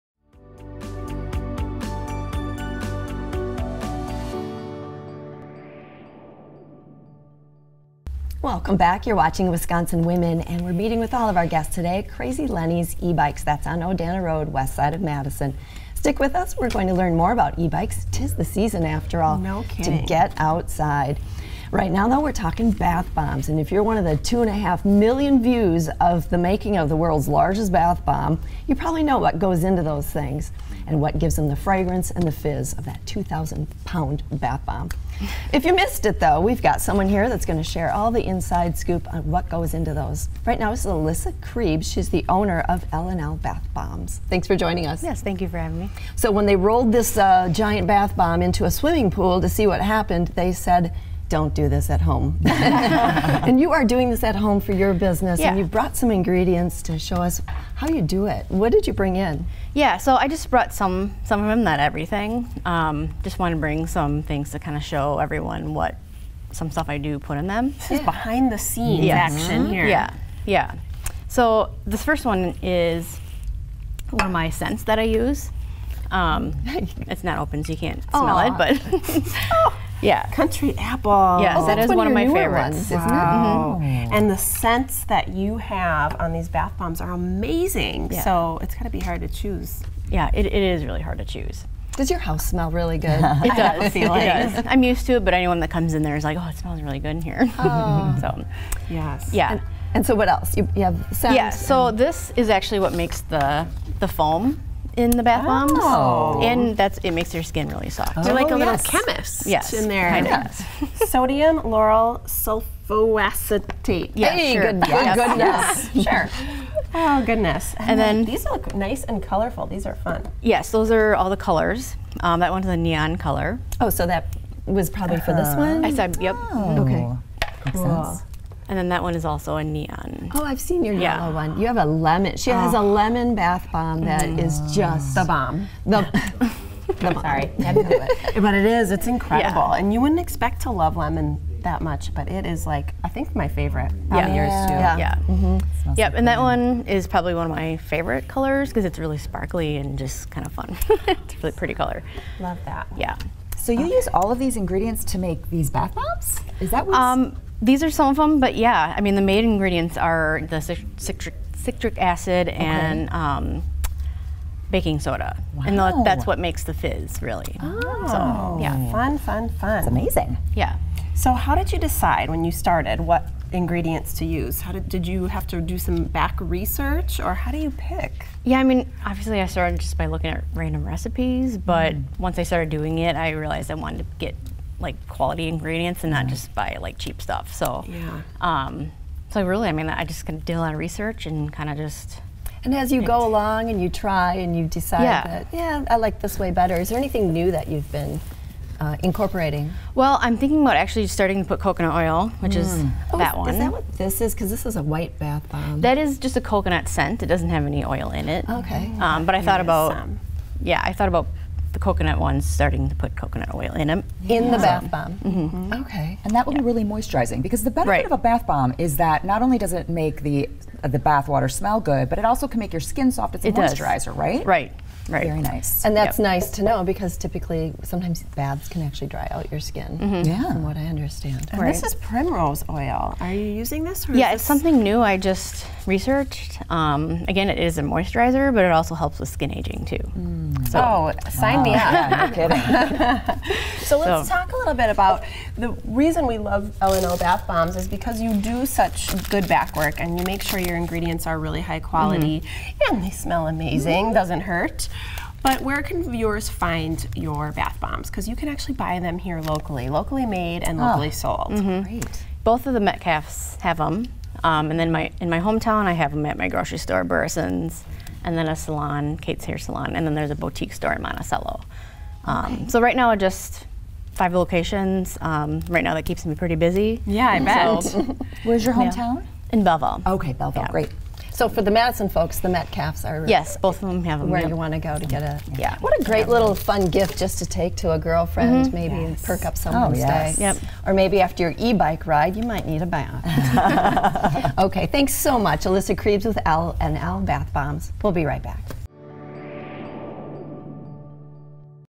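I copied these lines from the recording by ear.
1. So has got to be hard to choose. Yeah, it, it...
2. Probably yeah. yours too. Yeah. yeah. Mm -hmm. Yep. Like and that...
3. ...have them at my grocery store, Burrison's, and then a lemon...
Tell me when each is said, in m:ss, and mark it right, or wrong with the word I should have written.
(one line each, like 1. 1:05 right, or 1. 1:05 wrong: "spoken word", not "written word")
1. 1:28 right
2. 2:24 right
3. 4:25 wrong: "salon", not "lemon".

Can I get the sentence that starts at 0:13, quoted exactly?
That's on Odana Road, west side of Madison.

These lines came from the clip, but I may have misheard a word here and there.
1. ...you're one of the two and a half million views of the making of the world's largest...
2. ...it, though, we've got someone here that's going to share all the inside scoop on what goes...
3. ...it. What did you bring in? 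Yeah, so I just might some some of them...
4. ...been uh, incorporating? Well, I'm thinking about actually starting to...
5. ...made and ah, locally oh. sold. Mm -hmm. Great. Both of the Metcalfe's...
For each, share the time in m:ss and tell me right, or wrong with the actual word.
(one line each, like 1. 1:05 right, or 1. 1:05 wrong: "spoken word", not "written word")
1. 0:23 right
2. 0:36 right
3. 0:58 wrong: "brought", not "might"
4. 3:17 right
5. 4:20 right.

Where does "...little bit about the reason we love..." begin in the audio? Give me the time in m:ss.
4:04.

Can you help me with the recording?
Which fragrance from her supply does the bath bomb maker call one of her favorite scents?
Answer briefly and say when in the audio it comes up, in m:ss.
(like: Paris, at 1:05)
Country apple, at 1:20.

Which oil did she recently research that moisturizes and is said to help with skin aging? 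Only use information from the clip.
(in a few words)
Primrose oil.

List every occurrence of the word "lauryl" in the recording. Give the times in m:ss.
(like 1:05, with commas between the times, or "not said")
1:51.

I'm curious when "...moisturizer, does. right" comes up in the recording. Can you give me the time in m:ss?
3:43.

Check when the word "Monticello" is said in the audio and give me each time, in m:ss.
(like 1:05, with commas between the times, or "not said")
4:31.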